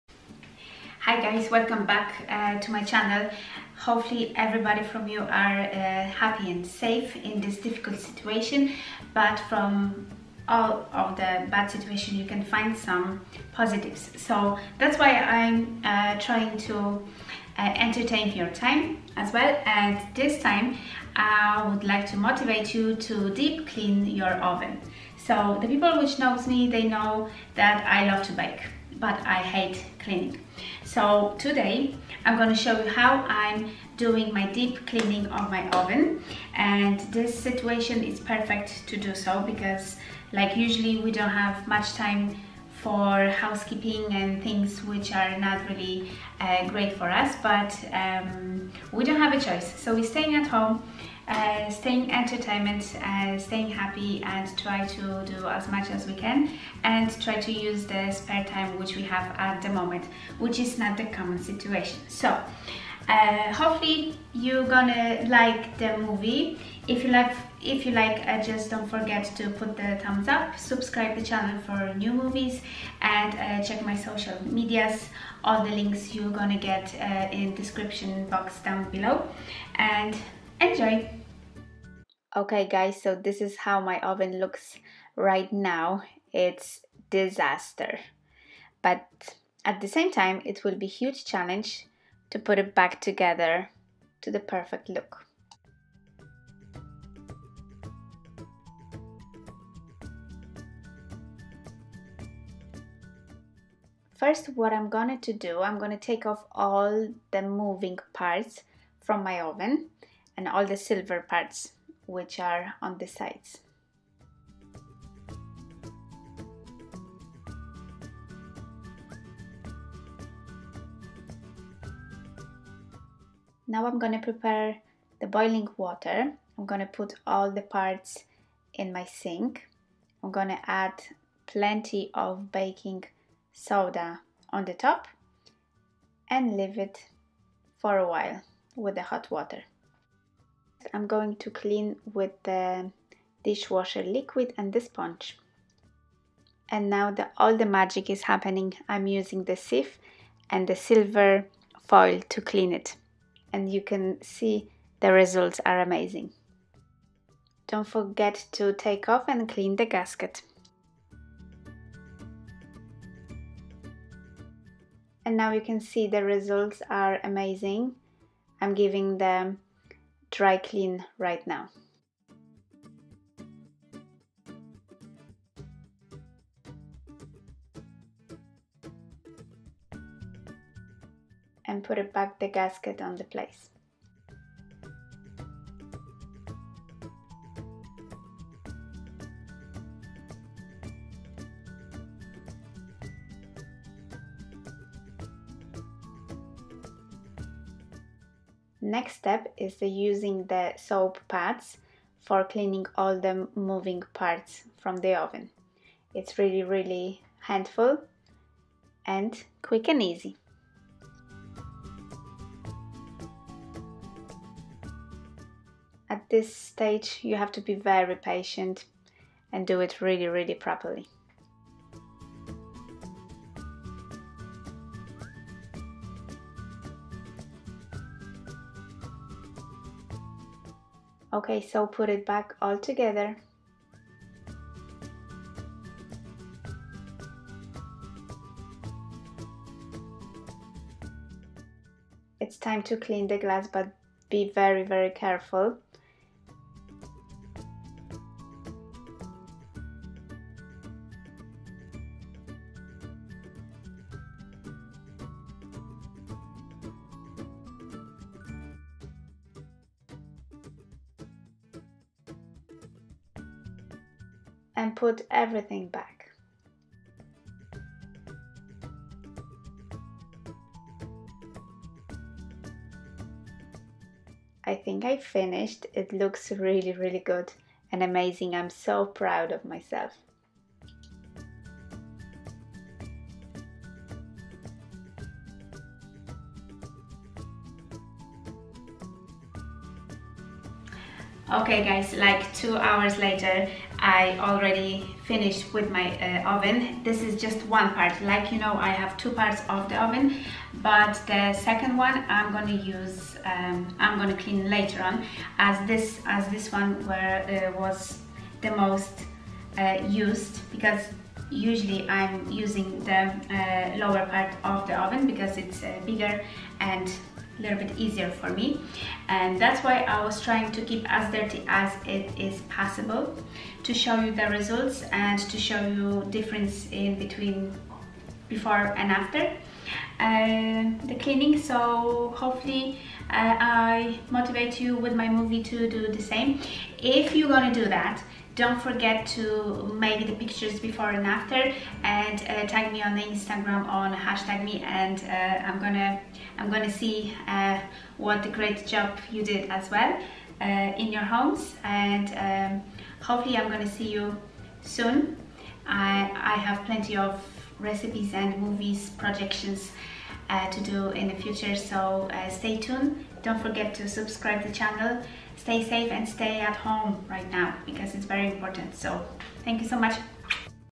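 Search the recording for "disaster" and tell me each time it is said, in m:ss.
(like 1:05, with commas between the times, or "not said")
1:27.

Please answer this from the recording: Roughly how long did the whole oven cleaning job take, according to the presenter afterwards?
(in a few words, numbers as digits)
2 hours.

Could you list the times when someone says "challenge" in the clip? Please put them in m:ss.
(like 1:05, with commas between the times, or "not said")
1:31.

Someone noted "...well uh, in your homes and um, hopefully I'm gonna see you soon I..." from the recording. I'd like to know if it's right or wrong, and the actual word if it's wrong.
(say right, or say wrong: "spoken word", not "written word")
right.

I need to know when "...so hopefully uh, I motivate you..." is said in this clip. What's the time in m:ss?
5:31.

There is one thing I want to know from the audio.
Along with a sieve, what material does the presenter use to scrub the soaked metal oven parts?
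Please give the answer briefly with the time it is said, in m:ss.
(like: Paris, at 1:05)
silver foil, at 2:30.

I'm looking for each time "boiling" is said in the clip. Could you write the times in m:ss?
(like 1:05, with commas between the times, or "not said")
2:05.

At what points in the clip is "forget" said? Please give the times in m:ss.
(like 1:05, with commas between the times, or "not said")
1:08, 2:37, 5:38, 6:03.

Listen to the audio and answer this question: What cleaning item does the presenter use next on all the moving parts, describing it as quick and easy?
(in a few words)
soap pads.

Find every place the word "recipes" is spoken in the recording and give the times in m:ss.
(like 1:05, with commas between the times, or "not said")
5:57.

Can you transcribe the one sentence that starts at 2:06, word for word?
I'm gonna put all the parts in my sink.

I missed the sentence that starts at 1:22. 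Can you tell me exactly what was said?
Okay, guys, so this is how my oven looks right now.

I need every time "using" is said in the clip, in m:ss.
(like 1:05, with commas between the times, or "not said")
2:29, 3:19, 5:12.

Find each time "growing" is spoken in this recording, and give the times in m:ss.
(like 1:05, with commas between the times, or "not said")
not said.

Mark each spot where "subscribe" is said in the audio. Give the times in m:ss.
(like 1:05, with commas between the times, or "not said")
1:10, 6:04.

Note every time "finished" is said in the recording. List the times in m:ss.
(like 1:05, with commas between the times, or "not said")
4:35, 4:55.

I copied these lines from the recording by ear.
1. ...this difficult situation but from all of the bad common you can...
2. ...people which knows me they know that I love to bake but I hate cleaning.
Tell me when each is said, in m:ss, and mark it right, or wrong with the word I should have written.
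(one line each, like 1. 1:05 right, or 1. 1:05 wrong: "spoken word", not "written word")
1. 0:07 wrong: "situation", not "common"
2. 0:25 right.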